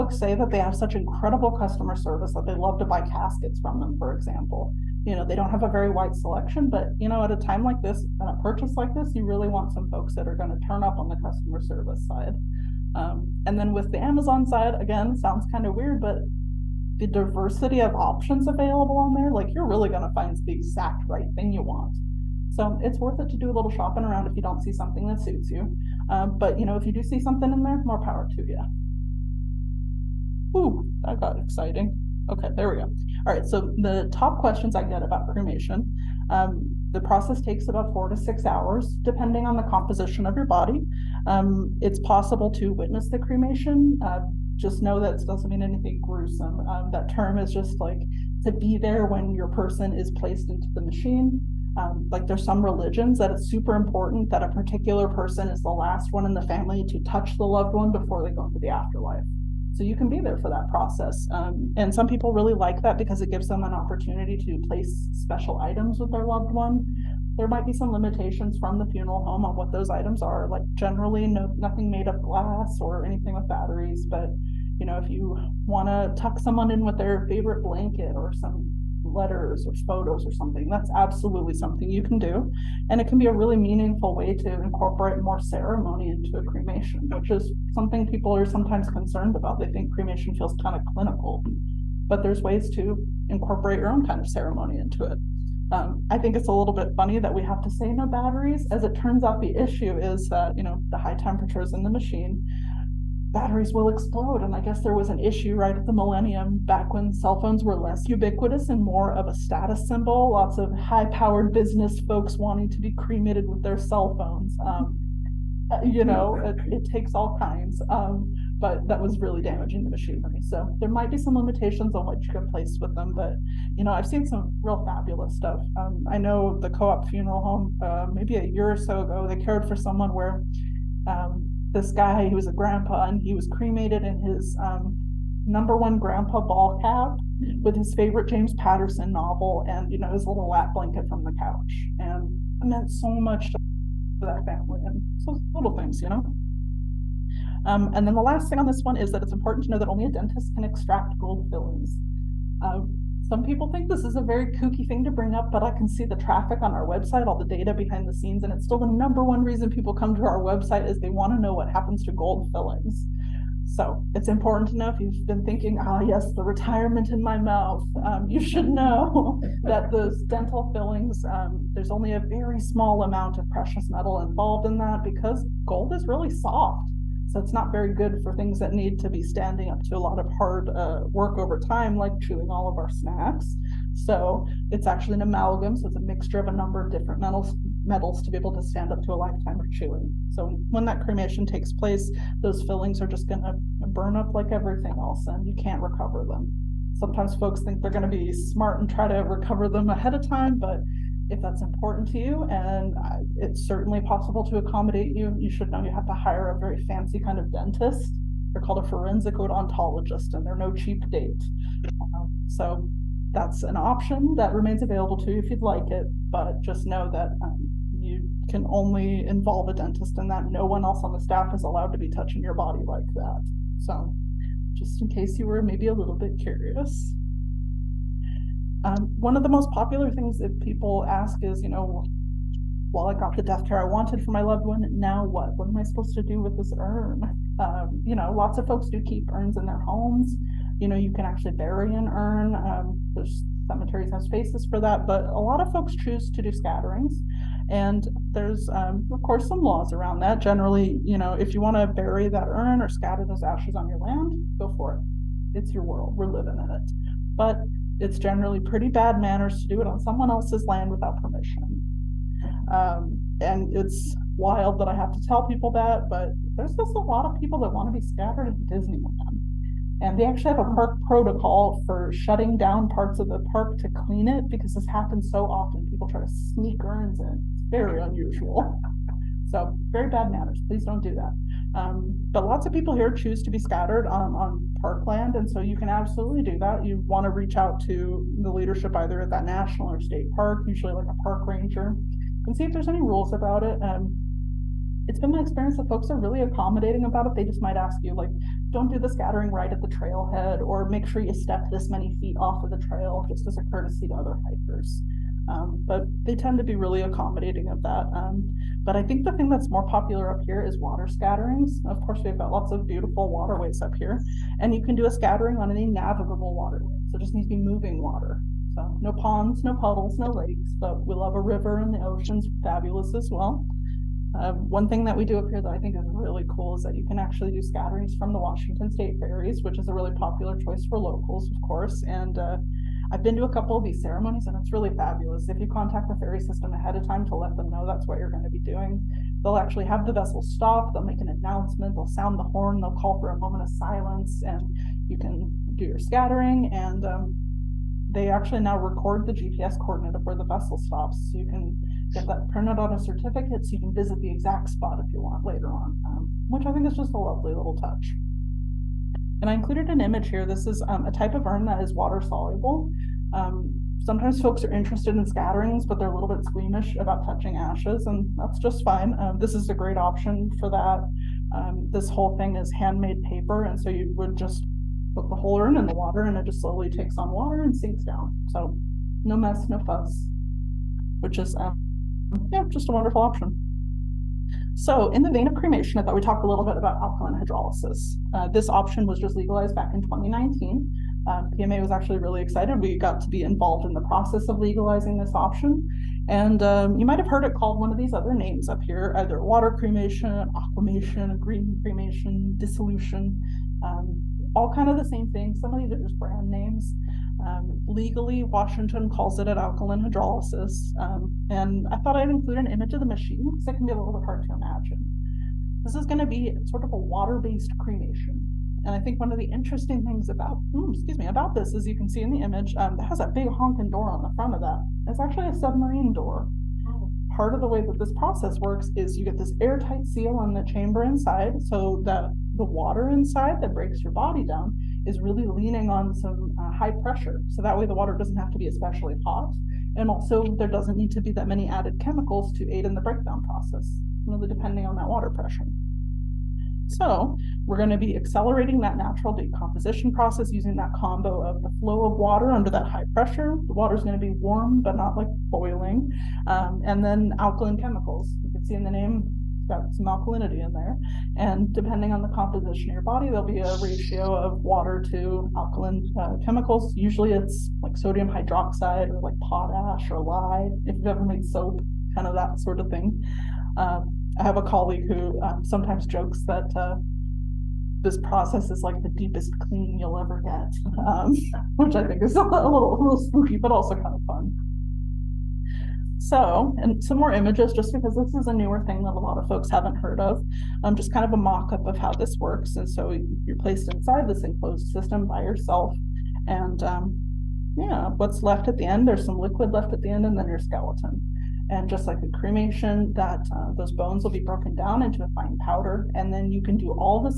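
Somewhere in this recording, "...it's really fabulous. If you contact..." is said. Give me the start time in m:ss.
5:34.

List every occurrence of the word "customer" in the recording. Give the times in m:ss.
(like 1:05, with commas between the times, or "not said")
0:01, 0:11.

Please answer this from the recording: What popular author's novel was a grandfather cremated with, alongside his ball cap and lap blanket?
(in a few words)
James Patterson.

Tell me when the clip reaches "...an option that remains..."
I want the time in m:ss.
3:33.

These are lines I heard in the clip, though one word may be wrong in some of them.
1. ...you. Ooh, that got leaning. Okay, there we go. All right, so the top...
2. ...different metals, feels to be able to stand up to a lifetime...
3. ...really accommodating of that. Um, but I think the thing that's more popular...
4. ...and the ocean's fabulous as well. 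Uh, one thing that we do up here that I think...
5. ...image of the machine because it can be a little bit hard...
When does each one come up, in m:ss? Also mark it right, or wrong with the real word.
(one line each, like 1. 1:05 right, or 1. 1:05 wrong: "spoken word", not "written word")
1. 0:28 wrong: "exciting", not "leaning"
2. 3:06 wrong: "metals", not "feels"
3. 5:06 right
4. 5:21 right
5. 6:52 right.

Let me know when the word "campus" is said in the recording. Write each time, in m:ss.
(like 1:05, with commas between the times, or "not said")
not said.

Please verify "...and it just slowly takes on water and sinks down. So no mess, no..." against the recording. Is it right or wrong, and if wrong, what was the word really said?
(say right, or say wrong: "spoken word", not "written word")
right.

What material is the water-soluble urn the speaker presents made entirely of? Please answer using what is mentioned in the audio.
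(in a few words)
Handmade paper.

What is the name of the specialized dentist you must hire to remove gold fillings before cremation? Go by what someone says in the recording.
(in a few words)
Forensic odontologist.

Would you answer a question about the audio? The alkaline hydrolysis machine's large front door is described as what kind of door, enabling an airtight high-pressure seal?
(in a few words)
Submarine door.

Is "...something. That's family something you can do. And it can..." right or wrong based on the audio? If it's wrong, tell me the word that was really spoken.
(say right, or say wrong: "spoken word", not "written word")
wrong: "absolutely", not "family".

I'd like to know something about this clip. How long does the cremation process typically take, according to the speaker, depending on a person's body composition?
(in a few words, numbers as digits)
4 to 6 hours.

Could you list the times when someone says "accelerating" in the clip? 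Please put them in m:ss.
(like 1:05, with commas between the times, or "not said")
7:28.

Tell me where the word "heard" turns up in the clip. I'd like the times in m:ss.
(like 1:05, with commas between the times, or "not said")
6:37, 8:09.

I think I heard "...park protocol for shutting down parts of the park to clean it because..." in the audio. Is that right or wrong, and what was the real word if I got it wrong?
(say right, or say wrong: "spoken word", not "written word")
right.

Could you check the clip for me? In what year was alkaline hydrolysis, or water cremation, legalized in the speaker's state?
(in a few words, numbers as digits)
2019.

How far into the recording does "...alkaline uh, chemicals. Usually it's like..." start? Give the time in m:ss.
7:45.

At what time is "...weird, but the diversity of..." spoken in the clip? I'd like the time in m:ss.
0:15.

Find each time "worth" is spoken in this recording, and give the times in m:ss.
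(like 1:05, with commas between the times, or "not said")
0:22.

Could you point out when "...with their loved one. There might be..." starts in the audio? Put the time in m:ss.
1:05.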